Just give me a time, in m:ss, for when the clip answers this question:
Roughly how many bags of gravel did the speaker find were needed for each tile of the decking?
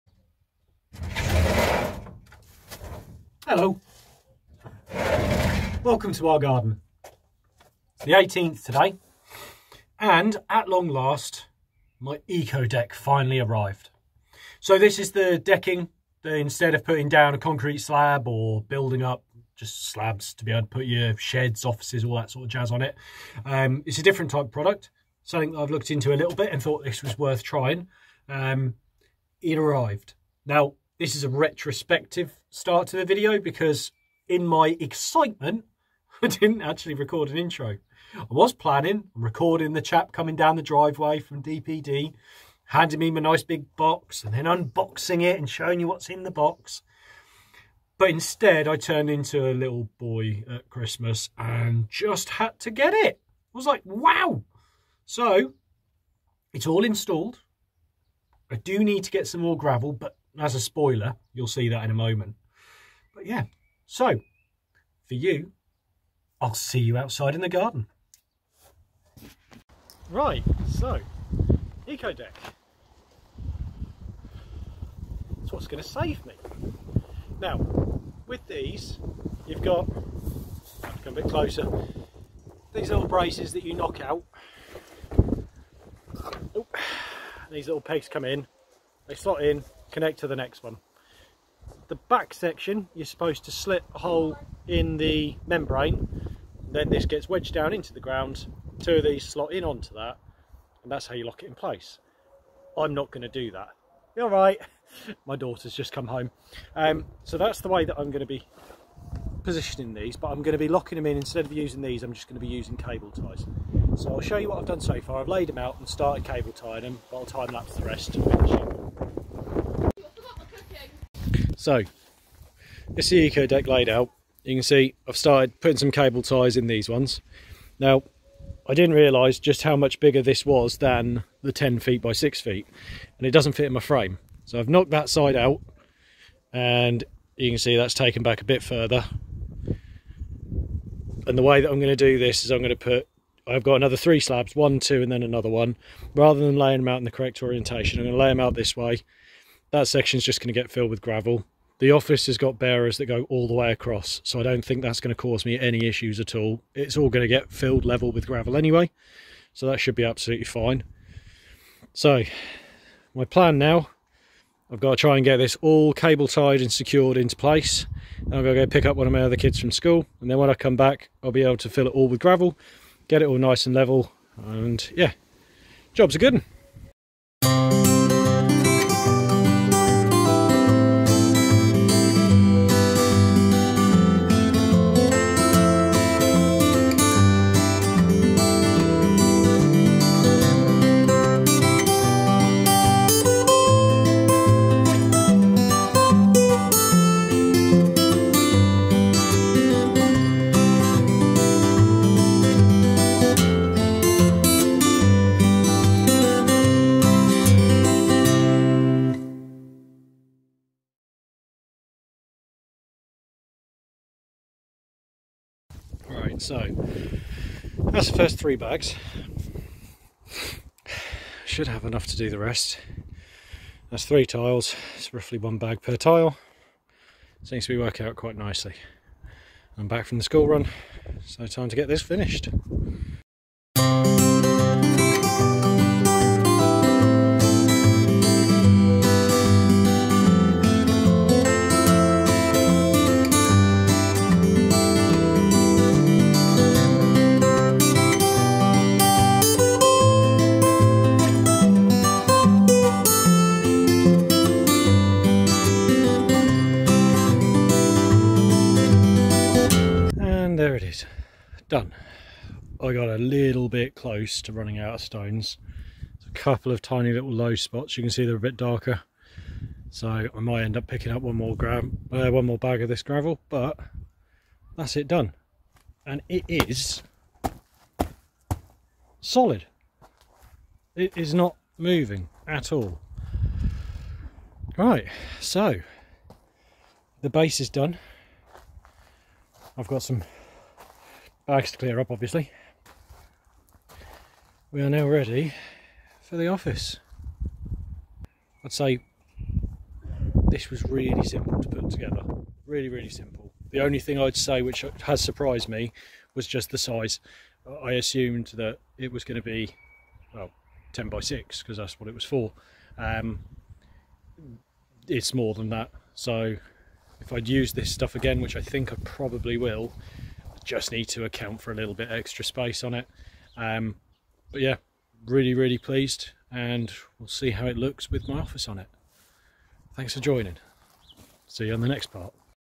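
3:45.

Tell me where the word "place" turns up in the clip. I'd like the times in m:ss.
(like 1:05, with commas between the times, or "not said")
1:41, 2:47.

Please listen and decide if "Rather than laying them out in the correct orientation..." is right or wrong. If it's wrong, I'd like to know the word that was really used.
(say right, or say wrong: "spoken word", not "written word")
right.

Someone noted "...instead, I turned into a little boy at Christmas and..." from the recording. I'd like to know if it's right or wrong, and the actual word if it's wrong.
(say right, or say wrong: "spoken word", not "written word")
right.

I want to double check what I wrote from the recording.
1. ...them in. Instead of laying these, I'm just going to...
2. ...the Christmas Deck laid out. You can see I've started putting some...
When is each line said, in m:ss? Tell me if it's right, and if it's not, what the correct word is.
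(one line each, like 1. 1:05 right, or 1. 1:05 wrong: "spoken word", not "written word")
1. 1:50 wrong: "using", not "laying"
2. 2:03 wrong: "Eco", not "Christmas".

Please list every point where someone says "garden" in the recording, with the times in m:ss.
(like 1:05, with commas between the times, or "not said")
0:06, 1:07.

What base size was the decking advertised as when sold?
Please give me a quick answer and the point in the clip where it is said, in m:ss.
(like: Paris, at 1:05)
10 feet by 6 feet, at 2:11.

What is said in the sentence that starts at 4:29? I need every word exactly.
So I might end up picking up one more gram, uh, one more bag of this gravel, but that's it done.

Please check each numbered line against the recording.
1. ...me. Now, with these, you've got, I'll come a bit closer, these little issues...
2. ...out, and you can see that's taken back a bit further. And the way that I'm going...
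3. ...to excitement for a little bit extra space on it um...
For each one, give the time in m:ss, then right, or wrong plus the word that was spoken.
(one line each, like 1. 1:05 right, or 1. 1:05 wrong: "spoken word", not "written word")
1. 1:16 wrong: "braces", not "issues"
2. 2:15 right
3. 5:21 wrong: "account", not "excitement".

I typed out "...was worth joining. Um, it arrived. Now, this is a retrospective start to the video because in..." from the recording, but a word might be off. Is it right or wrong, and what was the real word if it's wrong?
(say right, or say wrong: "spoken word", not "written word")
wrong: "trying", not "joining".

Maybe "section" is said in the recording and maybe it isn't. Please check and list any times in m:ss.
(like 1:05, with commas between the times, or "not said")
1:32, 2:29.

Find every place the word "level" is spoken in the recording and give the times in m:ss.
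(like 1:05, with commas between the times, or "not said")
2:37, 2:53.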